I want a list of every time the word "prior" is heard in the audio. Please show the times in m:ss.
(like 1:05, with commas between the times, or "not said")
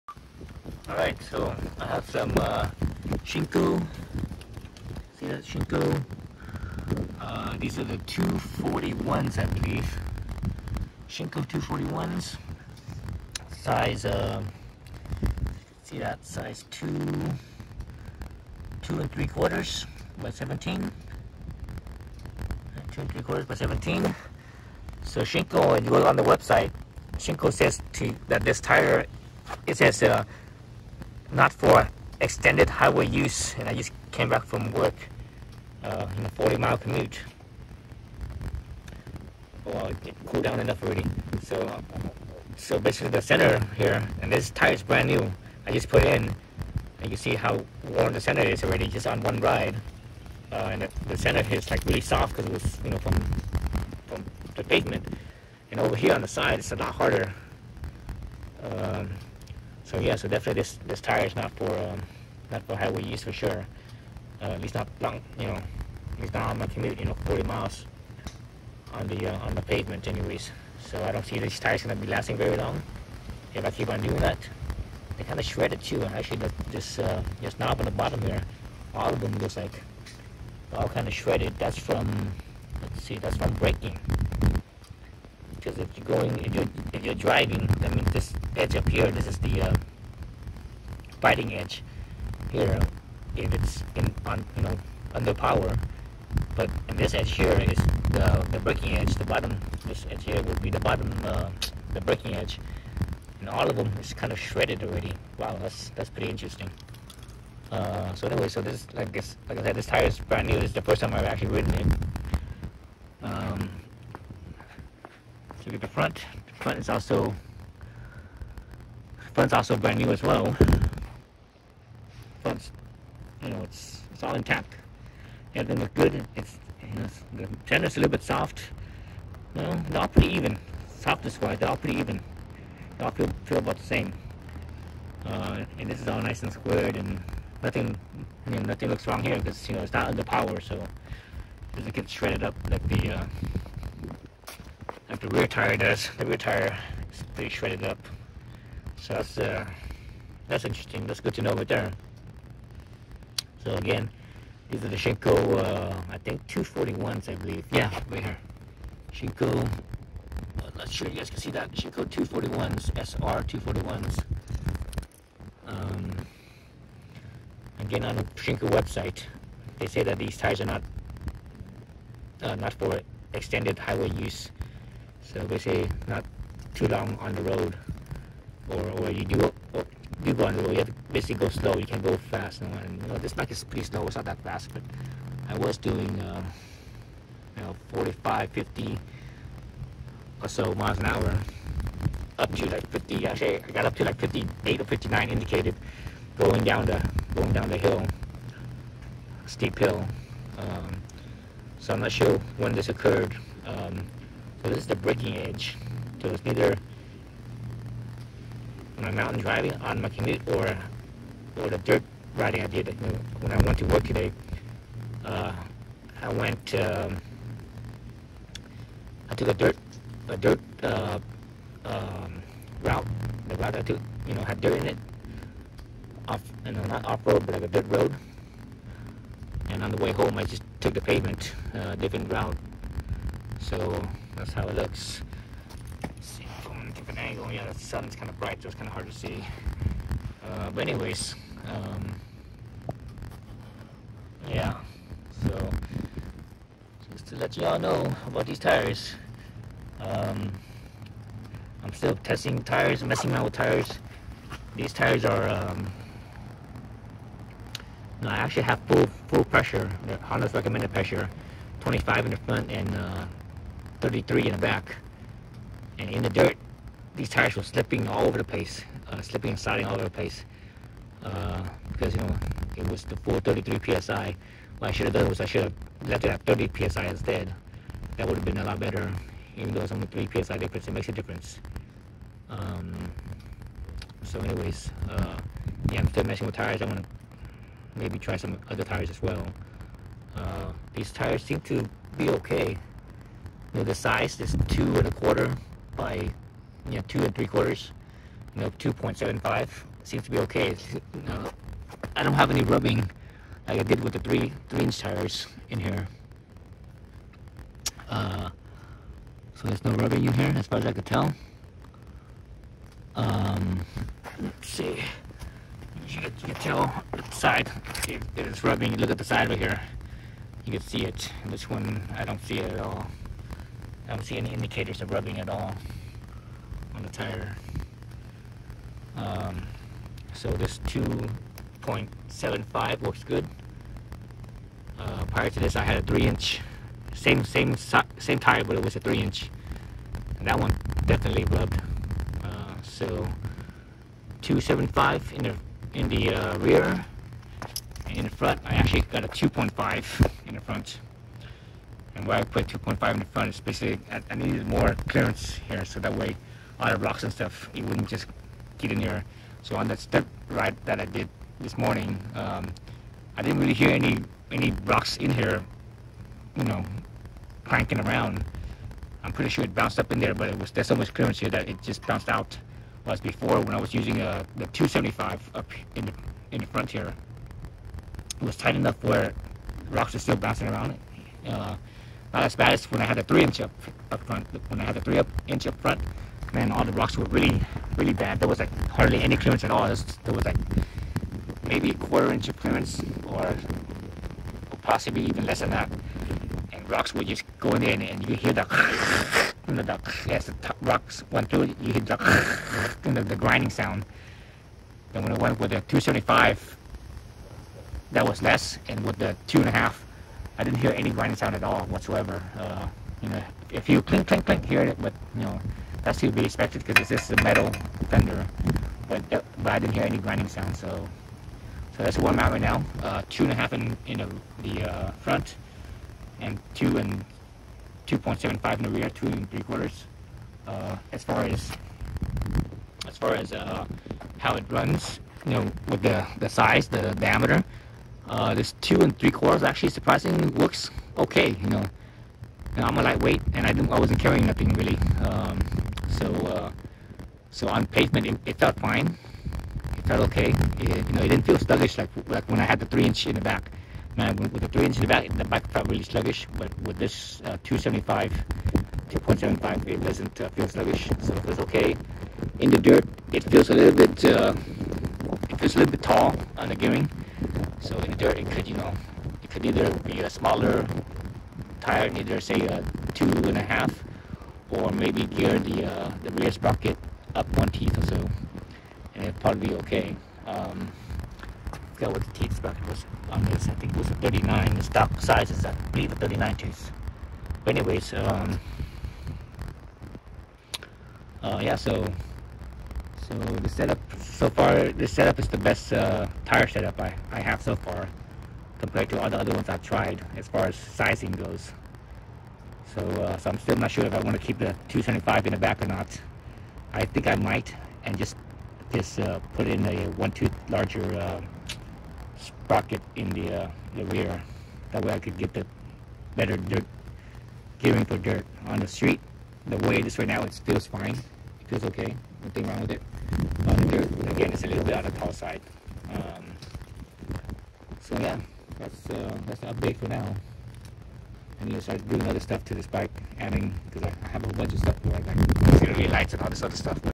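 5:35.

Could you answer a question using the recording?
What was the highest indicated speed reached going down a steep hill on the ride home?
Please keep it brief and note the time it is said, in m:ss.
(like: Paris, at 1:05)
58 or 59, at 3:14.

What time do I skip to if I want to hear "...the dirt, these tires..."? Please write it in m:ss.
4:26.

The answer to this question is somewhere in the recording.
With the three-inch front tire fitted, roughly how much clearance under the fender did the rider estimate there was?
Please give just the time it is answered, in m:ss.
6:31.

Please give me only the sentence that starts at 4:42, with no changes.
Um, so anyways, uh, yeah, I'm still messing with tires.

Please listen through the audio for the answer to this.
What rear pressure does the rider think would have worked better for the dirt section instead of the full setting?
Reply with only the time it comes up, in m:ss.
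4:36.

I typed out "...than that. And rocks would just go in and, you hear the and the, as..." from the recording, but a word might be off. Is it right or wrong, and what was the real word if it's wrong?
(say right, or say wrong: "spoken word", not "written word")
right.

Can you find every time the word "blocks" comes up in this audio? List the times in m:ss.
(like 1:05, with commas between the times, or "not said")
5:56, 6:04.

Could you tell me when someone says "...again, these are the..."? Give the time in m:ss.
2:33.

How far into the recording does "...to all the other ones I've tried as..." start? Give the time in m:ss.
8:19.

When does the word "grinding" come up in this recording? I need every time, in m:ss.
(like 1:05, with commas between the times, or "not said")
6:43, 6:51, 7:00.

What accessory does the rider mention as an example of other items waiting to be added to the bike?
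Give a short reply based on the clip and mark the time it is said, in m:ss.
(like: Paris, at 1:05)
auxiliary lights, at 8:55.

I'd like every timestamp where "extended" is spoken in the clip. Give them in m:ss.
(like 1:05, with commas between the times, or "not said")
0:32, 2:53.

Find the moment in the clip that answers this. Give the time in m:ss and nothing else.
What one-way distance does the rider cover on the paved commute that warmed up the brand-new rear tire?
0:36.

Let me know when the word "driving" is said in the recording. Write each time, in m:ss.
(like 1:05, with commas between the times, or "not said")
1:27, 3:29.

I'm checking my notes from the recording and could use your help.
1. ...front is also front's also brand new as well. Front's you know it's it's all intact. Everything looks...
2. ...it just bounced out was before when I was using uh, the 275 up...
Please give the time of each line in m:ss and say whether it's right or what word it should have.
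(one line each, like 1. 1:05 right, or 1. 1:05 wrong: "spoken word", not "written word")
1. 1:56 right
2. 6:11 right.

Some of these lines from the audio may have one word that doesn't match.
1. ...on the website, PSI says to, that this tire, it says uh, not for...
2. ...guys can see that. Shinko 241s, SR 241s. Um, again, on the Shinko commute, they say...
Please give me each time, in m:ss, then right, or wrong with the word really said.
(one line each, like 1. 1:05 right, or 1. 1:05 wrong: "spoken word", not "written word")
1. 0:26 wrong: "Shinko", not "PSI"
2. 2:41 wrong: "website", not "commute".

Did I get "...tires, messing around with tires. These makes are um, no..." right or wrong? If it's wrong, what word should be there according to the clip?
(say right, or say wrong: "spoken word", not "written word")
wrong: "tires", not "makes".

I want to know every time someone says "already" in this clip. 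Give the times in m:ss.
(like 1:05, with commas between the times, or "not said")
0:40, 0:48, 1:44.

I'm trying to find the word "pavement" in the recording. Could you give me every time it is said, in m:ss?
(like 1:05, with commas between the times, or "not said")
0:54, 1:09, 3:51, 7:27.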